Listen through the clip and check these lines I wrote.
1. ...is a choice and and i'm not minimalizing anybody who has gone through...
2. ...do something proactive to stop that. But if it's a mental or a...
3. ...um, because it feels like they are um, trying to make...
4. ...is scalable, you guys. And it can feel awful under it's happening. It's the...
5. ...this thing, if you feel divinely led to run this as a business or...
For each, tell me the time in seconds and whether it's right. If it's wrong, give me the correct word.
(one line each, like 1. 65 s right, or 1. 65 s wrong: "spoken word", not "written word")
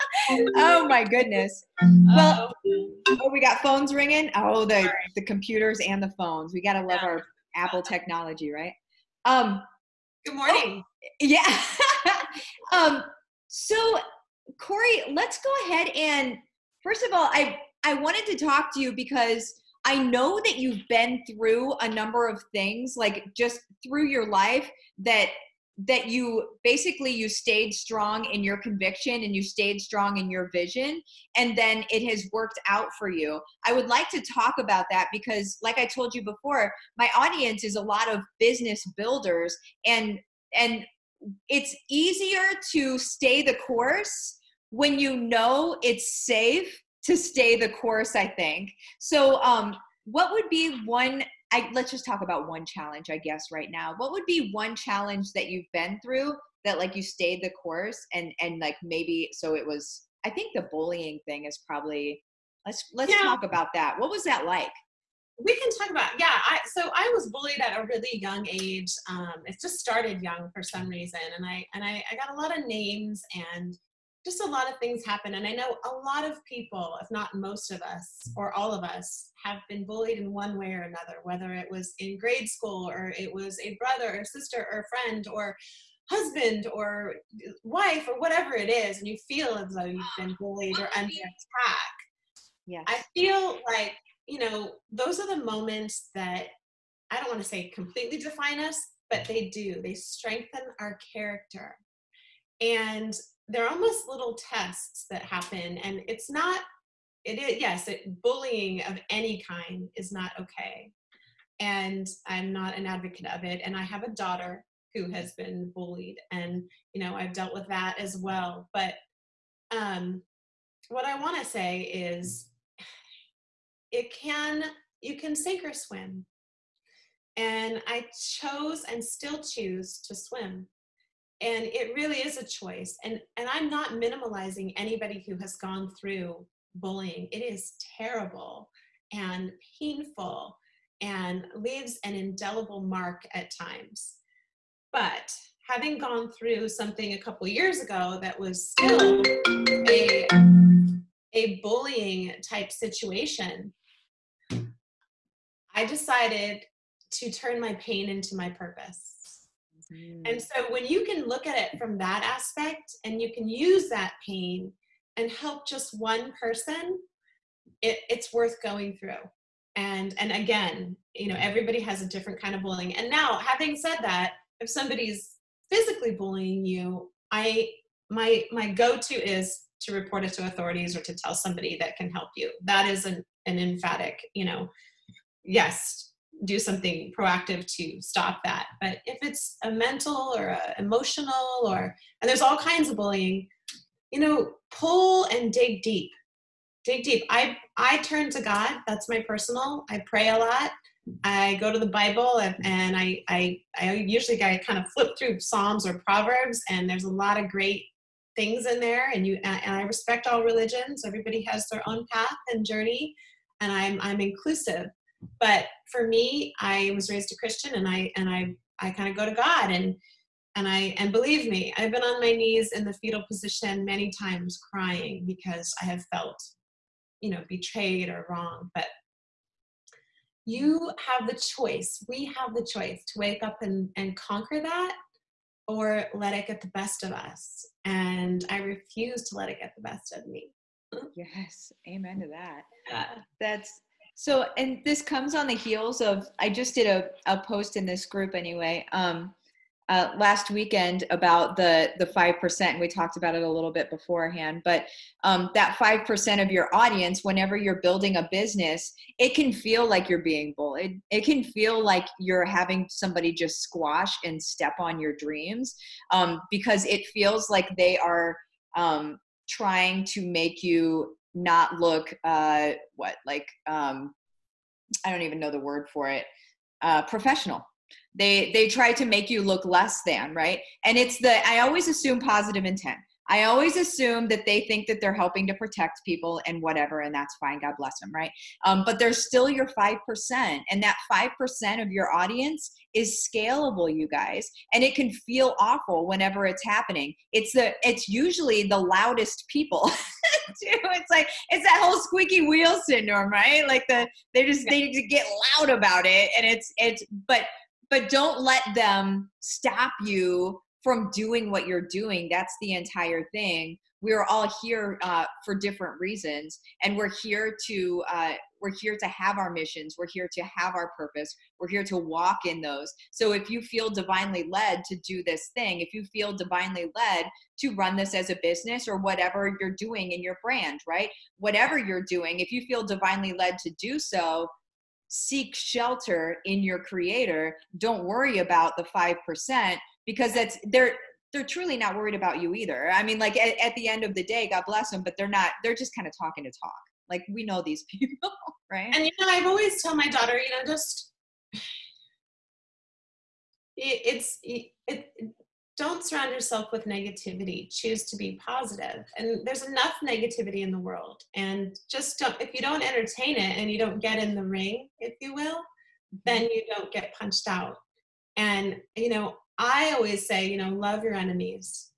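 1. 132 s right
2. 186 s right
3. 266 s right
4. 292 s wrong: "whenever", not "under"
5. 325 s right.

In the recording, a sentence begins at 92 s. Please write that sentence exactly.
Yeah, I feel like, you know, those are the moments that I don't want to say completely define us, but they do.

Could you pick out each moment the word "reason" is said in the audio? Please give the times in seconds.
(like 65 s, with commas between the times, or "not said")
70 s, 315 s.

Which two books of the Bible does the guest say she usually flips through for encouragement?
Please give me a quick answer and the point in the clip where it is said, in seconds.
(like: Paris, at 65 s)
Psalms or Proverbs, at 205 s.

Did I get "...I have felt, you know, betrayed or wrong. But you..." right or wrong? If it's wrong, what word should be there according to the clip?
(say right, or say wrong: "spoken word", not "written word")
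right.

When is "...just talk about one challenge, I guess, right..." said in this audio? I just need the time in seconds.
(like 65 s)
51 s.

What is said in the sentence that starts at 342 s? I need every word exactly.
I mean, like at, at the end of the day, God bless them, but they're not.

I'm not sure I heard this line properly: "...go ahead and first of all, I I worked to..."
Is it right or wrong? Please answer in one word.
wrong.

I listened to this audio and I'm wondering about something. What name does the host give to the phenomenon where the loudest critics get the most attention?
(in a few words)
squeaky wheel syndrome.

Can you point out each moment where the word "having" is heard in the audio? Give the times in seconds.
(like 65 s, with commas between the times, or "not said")
145 s, 173 s, 262 s.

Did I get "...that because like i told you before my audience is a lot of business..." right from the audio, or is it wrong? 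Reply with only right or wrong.
right.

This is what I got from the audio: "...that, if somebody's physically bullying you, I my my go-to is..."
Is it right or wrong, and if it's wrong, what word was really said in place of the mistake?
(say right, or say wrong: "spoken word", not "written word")
right.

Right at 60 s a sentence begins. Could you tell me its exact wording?
I think the bullying thing is probably.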